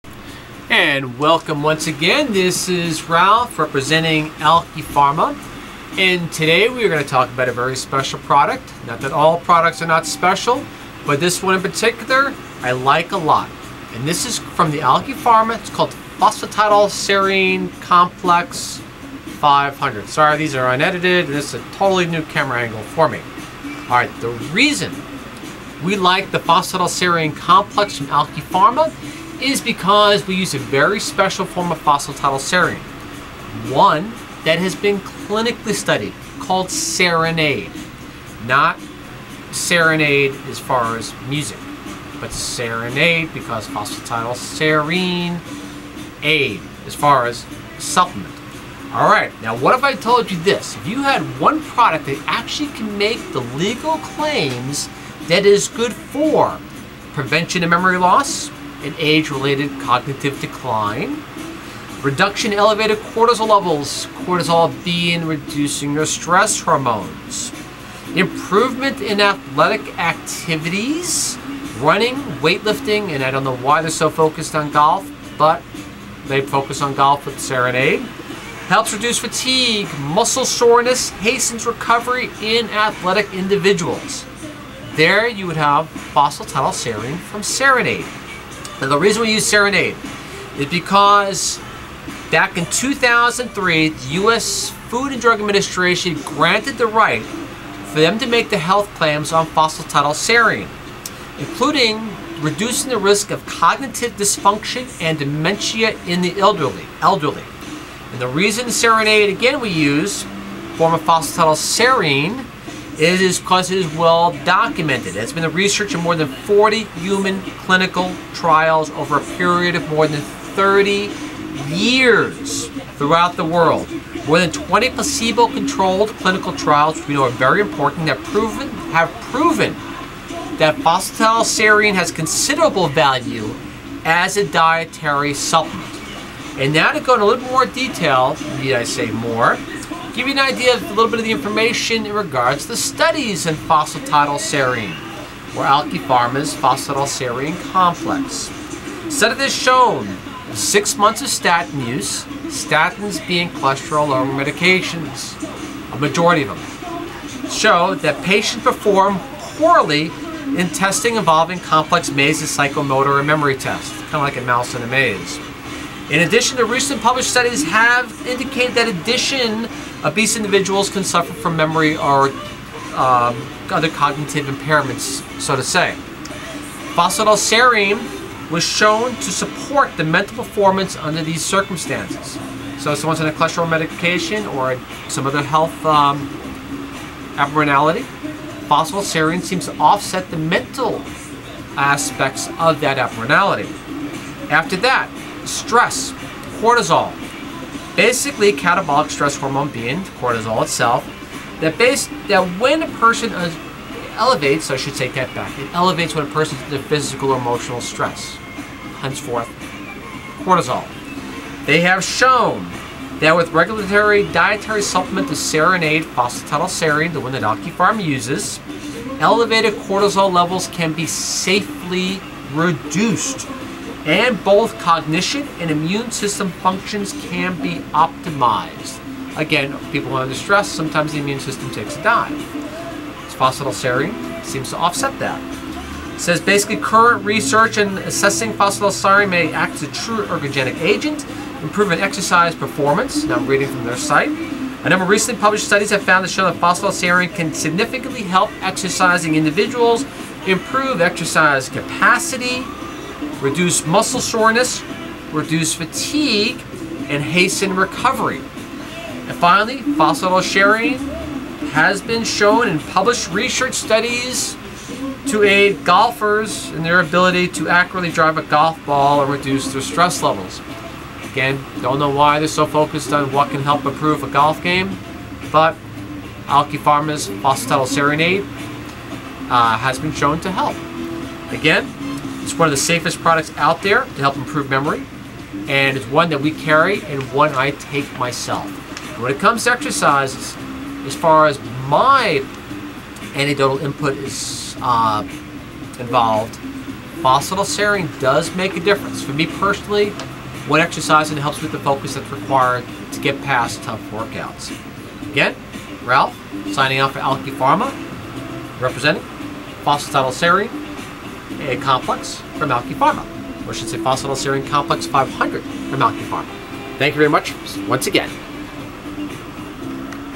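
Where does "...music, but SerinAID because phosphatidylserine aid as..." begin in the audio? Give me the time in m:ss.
0:41.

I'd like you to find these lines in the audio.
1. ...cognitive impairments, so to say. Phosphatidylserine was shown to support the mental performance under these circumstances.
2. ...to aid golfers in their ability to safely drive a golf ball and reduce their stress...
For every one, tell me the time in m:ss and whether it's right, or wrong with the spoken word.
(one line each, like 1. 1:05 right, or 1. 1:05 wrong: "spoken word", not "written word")
1. 2:53 right
2. 4:25 wrong: "accurately", not "safely".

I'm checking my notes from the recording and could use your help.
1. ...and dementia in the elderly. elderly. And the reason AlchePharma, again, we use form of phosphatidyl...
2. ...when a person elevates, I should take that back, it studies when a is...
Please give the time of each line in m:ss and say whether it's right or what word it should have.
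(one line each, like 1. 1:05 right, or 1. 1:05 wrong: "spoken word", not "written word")
1. 1:44 wrong: "SerinAID", not "AlchePharma"
2. 3:22 wrong: "elevates", not "studies".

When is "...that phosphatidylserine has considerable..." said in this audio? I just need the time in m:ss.
2:10.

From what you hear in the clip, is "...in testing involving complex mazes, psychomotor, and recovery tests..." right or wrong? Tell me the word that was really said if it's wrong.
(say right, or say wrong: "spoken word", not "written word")
wrong: "memory", not "recovery".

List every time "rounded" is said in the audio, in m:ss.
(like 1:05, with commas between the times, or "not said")
not said.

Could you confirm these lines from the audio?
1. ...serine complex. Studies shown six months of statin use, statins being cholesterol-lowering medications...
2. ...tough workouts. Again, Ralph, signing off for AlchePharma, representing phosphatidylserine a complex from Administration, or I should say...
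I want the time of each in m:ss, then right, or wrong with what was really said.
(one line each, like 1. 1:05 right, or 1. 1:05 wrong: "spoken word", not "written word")
1. 2:26 right
2. 5:03 wrong: "AlchePharma", not "Administration".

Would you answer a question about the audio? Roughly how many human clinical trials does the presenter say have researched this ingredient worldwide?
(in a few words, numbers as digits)
more than 40.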